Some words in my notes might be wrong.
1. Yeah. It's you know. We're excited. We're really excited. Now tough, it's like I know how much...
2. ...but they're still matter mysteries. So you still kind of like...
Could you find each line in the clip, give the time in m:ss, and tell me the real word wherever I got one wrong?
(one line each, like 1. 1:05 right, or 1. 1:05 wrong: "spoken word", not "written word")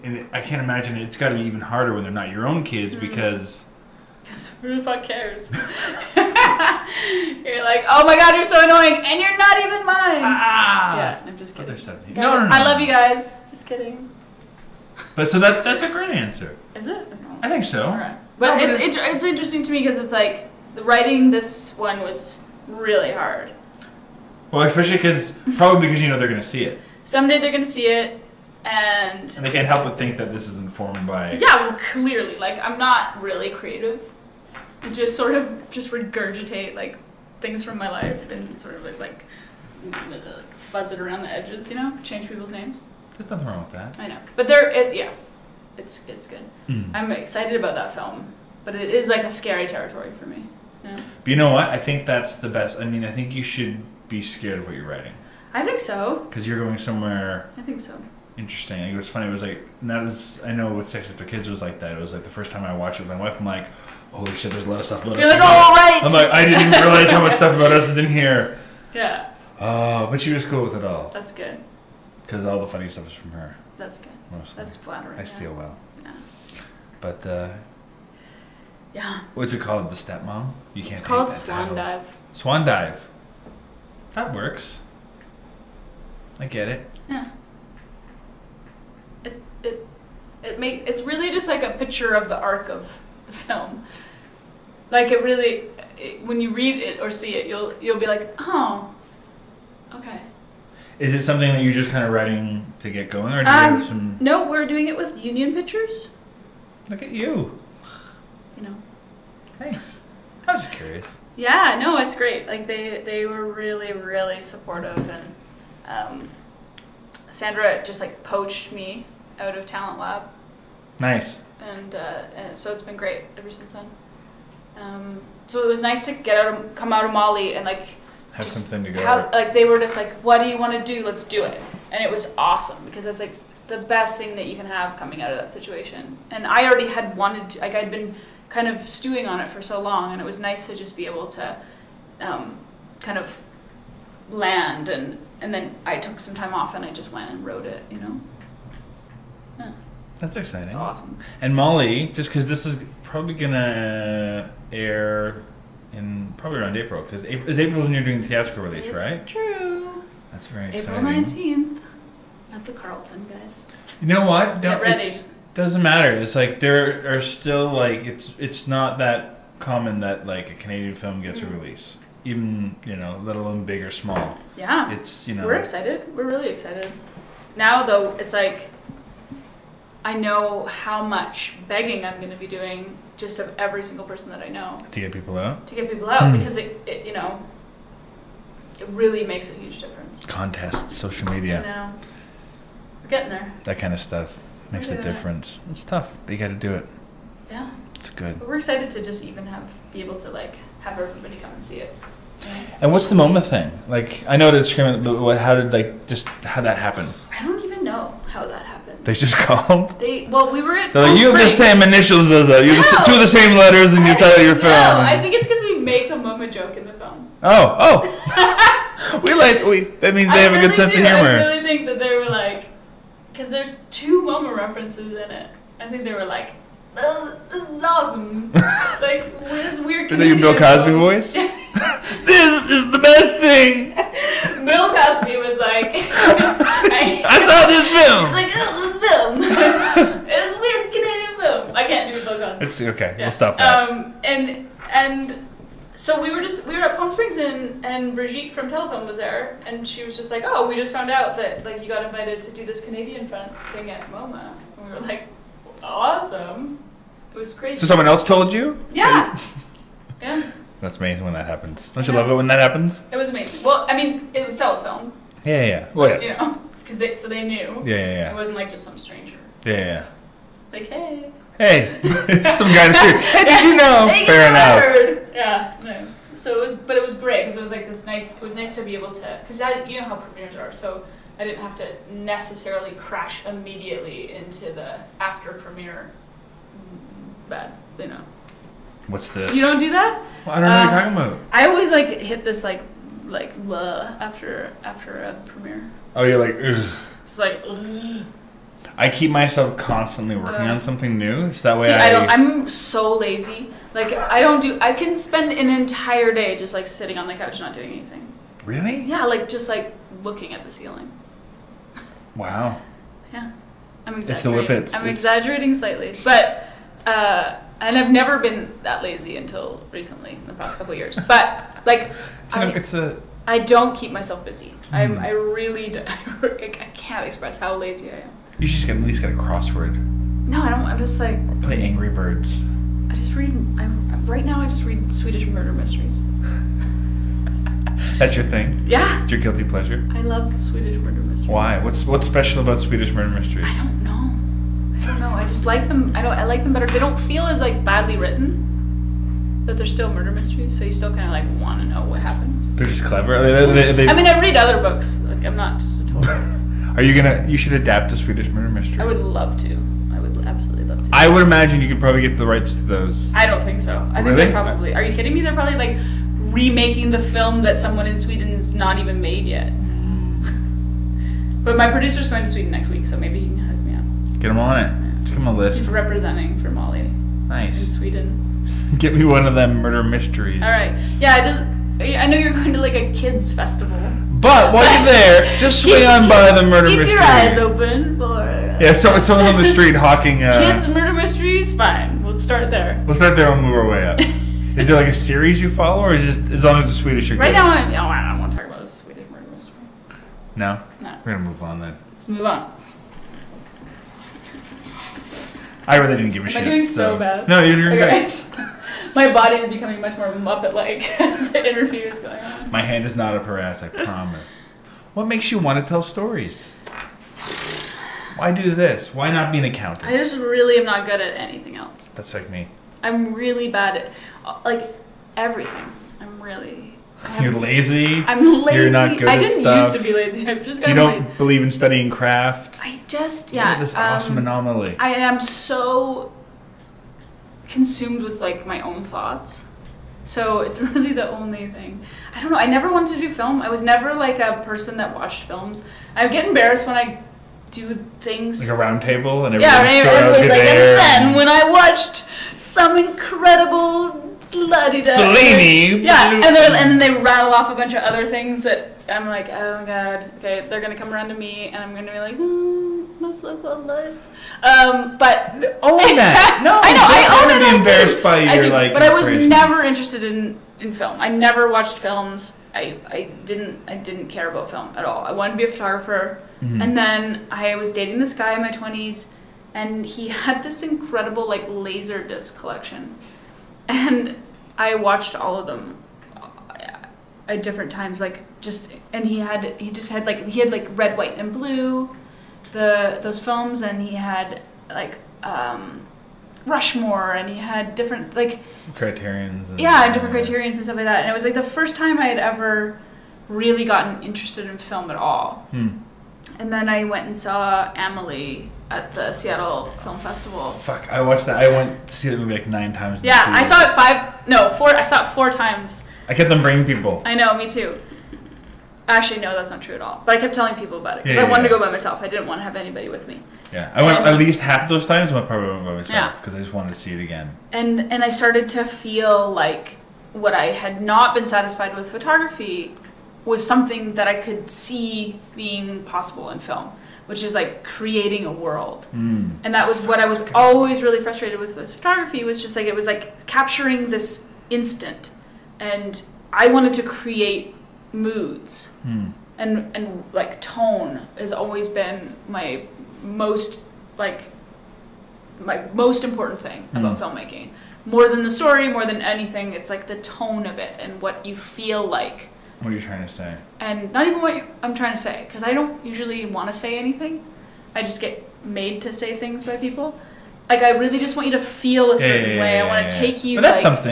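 1. 2:54 wrong: "though", not "tough"
2. 5:49 wrong: "murder", not "matter".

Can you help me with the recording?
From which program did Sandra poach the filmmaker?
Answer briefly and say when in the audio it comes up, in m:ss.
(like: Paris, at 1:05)
Talent Lab, at 1:59.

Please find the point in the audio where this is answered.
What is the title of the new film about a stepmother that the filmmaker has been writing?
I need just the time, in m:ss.
1:22.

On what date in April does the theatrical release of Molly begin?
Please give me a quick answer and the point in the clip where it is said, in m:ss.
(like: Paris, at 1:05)
April 19, at 2:40.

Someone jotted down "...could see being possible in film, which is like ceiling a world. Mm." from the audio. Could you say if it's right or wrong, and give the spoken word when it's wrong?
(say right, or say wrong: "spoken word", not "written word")
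wrong: "creating", not "ceiling".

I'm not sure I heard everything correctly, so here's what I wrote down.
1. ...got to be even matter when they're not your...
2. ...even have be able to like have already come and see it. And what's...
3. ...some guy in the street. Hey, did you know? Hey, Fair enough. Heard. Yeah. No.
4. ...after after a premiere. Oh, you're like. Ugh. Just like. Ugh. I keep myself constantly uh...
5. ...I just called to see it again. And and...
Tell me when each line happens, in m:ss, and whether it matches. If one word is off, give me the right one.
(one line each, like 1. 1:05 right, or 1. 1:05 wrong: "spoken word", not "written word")
1. 0:01 wrong: "harder", not "matter"
2. 3:19 wrong: "everybody", not "already"
3. 4:32 right
4. 4:54 right
5. 8:46 wrong: "wanted", not "called".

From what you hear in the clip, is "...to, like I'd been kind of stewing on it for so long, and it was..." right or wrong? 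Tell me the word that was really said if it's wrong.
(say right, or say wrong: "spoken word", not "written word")
right.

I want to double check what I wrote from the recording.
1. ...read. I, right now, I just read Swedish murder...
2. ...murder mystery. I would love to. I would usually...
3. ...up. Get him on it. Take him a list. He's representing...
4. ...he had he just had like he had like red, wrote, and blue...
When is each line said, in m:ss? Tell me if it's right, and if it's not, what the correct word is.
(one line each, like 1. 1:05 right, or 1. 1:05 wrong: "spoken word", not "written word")
1. 5:33 right
2. 5:58 wrong: "absolutely", not "usually"
3. 6:13 right
4. 8:09 wrong: "white", not "wrote".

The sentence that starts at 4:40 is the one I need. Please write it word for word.
So I didn't have to necessarily crash immediately into the after premiere bad.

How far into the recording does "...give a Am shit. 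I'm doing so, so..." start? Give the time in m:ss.
6:46.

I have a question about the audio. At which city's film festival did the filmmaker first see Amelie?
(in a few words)
Seattle.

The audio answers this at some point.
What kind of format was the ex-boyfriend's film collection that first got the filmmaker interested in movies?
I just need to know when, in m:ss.
8:01.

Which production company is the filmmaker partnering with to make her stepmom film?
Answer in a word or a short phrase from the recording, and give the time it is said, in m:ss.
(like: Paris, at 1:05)
Union Pictures, at 1:45.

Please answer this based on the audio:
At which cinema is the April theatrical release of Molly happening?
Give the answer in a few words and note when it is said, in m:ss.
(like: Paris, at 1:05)
The Carlton, at 2:42.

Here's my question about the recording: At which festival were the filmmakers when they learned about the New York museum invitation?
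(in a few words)
Palm Springs.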